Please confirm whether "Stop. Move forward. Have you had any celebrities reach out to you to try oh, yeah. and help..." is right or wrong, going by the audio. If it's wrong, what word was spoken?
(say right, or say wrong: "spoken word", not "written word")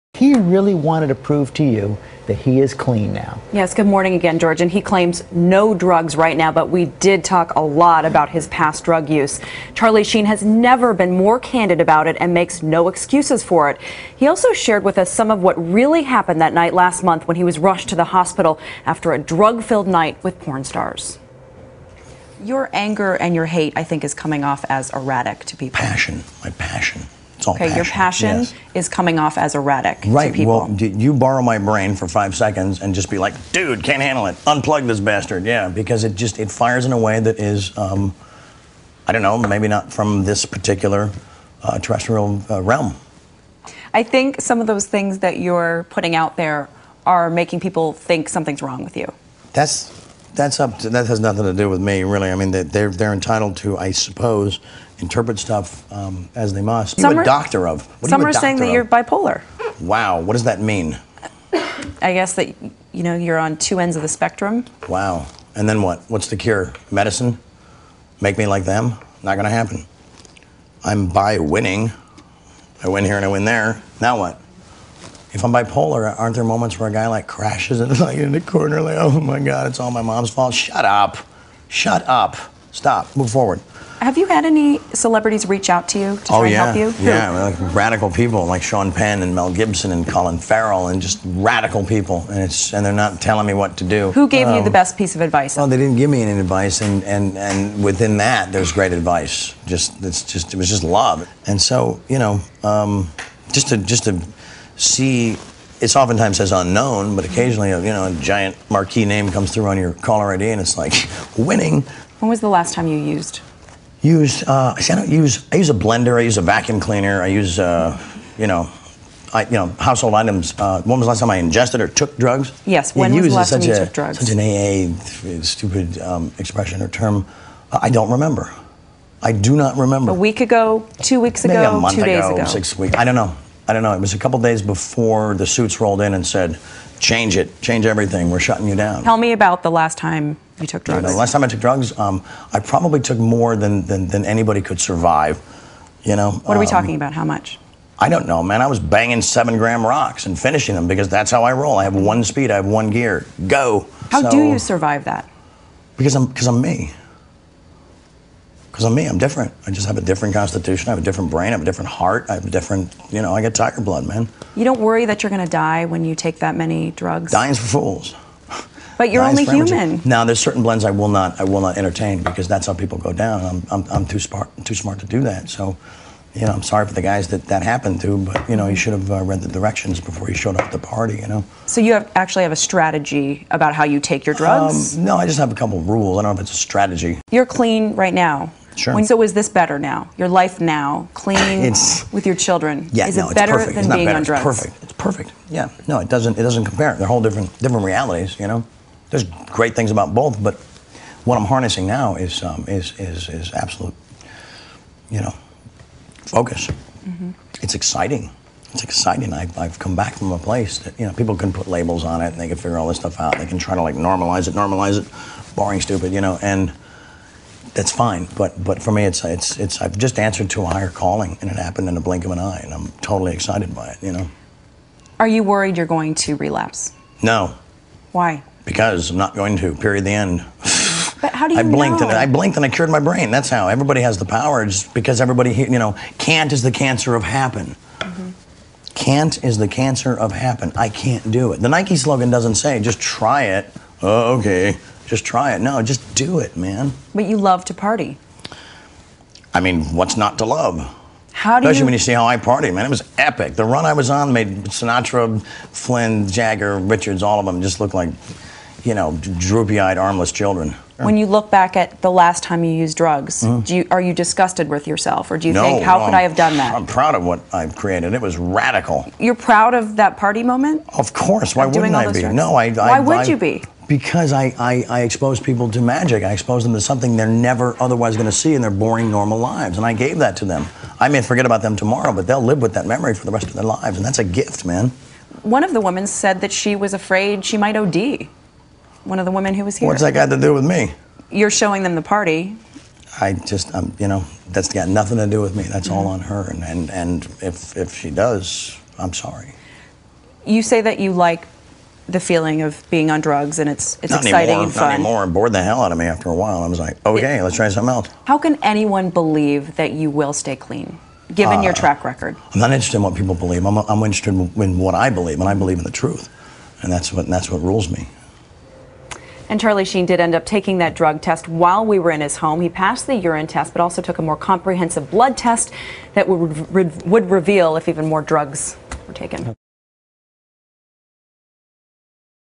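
right.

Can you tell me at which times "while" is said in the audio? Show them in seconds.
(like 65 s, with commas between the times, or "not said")
306 s, 321 s.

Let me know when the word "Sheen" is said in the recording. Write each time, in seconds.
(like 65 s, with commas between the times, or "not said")
10 s, 319 s.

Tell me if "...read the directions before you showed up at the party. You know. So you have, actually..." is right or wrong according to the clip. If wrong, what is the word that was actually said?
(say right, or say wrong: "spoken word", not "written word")
right.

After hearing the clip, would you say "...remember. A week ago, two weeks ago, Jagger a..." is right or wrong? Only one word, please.
wrong.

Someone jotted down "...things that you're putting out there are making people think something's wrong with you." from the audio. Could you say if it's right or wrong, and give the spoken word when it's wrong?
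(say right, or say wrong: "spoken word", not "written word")
right.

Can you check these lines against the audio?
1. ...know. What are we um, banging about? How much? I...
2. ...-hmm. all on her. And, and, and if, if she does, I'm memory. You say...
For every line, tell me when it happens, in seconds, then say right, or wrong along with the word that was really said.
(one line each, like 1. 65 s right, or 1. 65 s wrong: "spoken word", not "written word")
1. 146 s wrong: "talking", not "banging"
2. 295 s wrong: "sorry", not "memory".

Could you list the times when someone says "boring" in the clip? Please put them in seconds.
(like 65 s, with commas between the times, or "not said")
215 s, 278 s.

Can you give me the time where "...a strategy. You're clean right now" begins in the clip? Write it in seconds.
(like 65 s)
186 s.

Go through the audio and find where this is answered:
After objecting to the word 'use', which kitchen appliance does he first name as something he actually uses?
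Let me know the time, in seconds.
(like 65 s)
115 s.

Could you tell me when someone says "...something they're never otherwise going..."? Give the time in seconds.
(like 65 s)
276 s.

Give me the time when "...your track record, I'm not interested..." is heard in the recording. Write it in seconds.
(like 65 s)
311 s.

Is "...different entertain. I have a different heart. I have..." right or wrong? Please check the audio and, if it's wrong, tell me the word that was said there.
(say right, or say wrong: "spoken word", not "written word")
wrong: "brain", not "entertain".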